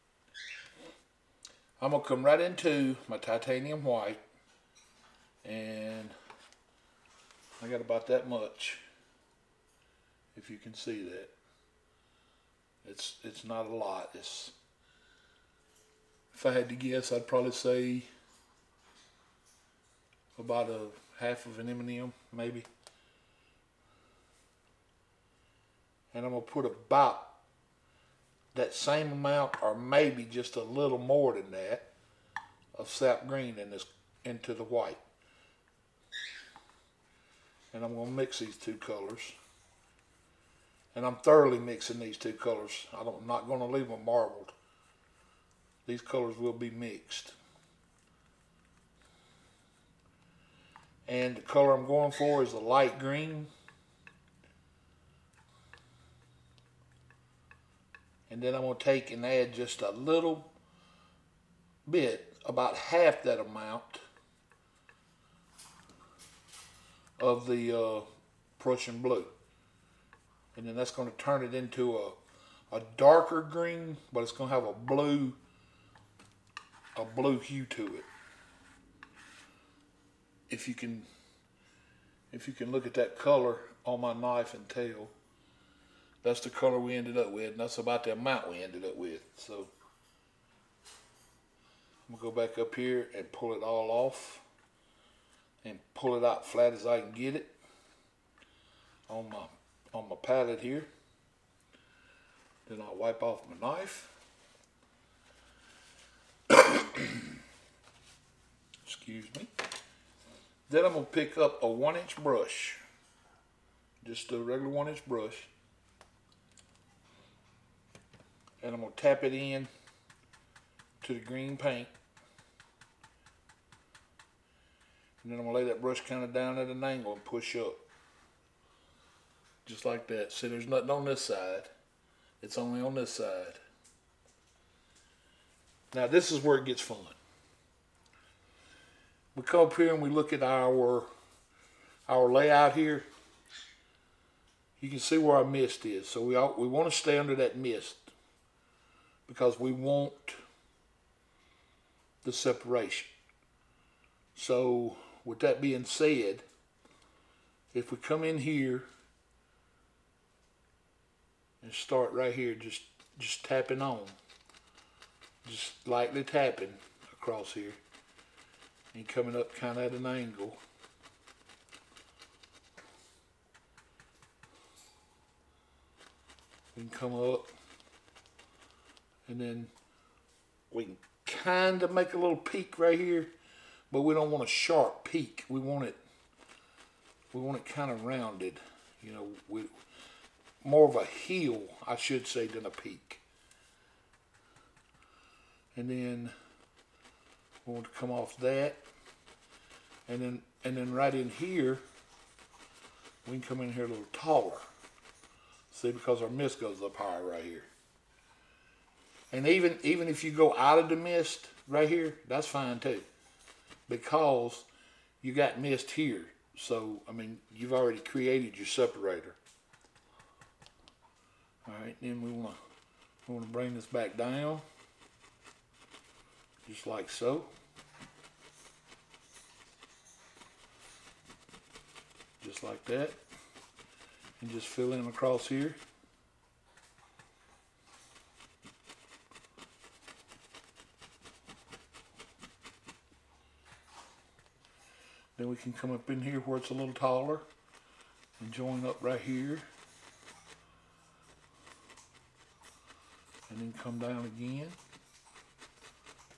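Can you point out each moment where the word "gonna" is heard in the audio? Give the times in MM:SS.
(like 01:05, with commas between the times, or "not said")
01:32, 01:50.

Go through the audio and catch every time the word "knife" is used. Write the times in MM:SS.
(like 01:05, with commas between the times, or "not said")
01:24, 01:43.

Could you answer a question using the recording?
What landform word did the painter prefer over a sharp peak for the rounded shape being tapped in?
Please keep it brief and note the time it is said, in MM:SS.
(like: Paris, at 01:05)
heel, at 03:11.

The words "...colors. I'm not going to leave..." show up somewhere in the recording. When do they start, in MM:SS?
00:42.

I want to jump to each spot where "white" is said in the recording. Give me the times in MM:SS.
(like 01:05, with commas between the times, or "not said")
00:03, 00:34.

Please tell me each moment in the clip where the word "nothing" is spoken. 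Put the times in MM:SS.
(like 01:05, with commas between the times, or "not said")
02:10.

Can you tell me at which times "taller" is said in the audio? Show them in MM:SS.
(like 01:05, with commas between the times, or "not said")
03:24, 04:06.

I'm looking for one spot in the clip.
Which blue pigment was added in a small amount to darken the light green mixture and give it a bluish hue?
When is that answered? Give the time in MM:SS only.
01:08.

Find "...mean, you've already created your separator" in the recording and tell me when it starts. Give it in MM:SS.
03:37.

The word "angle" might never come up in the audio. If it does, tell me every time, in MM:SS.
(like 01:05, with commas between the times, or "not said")
02:06, 02:50.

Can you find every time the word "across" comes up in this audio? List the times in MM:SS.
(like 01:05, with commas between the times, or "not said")
02:47, 03:55.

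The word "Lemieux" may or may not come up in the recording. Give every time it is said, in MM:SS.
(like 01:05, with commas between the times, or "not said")
not said.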